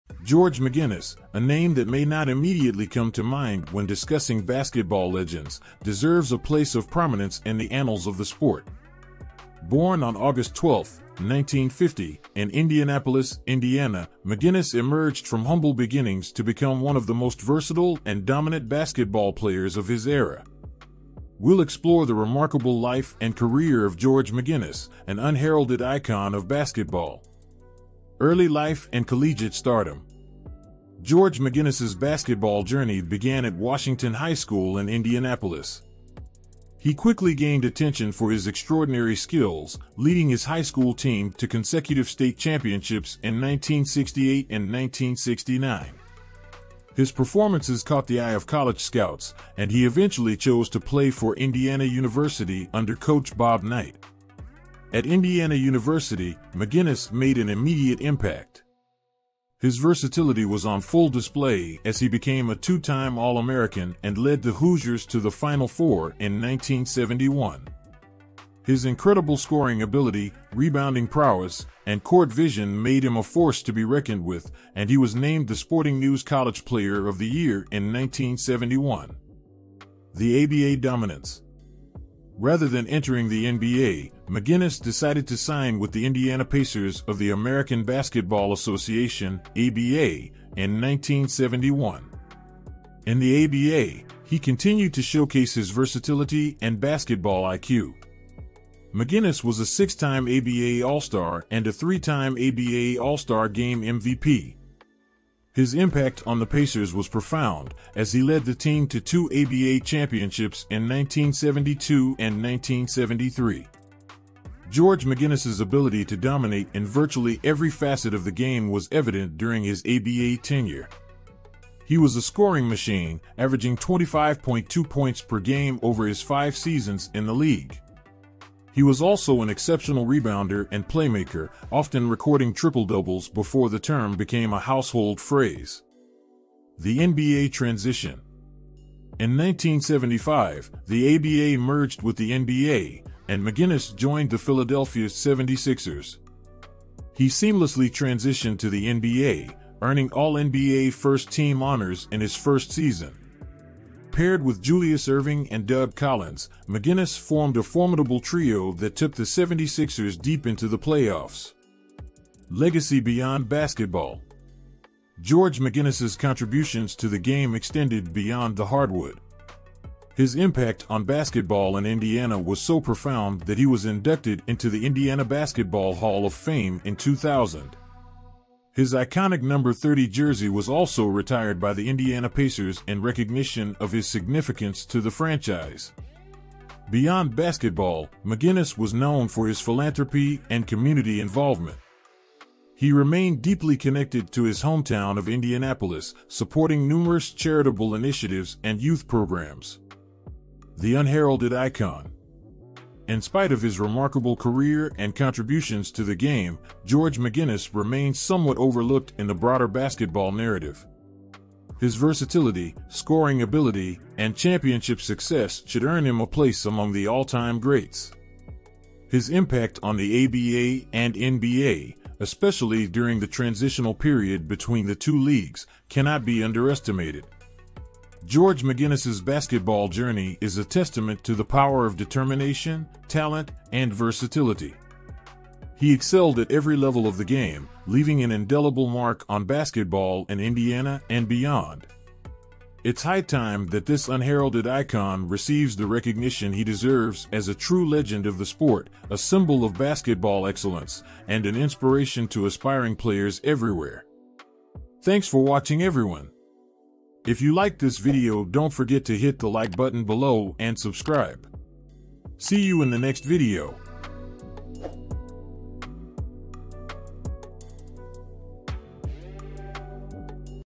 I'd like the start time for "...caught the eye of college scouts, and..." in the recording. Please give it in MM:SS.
00:47.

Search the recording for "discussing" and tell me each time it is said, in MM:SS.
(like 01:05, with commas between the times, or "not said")
00:03.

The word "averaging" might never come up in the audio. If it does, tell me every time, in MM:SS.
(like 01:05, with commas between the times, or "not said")
02:03.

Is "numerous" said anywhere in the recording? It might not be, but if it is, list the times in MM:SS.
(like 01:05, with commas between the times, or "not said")
03:16.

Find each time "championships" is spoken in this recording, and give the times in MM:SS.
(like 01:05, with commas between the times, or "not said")
00:42, 01:49, 03:34.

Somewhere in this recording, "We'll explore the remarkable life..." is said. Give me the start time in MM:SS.
00:21.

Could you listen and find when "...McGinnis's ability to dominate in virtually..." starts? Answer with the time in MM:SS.
01:55.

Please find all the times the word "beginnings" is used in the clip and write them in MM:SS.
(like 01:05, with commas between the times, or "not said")
00:15.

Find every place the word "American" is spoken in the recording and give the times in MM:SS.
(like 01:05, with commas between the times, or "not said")
01:03, 01:27.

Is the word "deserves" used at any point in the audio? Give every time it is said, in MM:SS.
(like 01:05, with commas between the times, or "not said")
00:05, 04:06.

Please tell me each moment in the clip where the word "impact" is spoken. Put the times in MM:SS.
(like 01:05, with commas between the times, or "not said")
00:58, 01:45, 02:50, 03:39.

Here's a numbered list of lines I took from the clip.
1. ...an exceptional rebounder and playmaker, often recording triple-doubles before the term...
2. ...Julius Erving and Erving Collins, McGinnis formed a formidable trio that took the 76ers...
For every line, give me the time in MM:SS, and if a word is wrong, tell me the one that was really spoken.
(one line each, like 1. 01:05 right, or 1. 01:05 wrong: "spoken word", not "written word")
1. 02:09 right
2. 02:34 wrong: "Doug", not "Erving".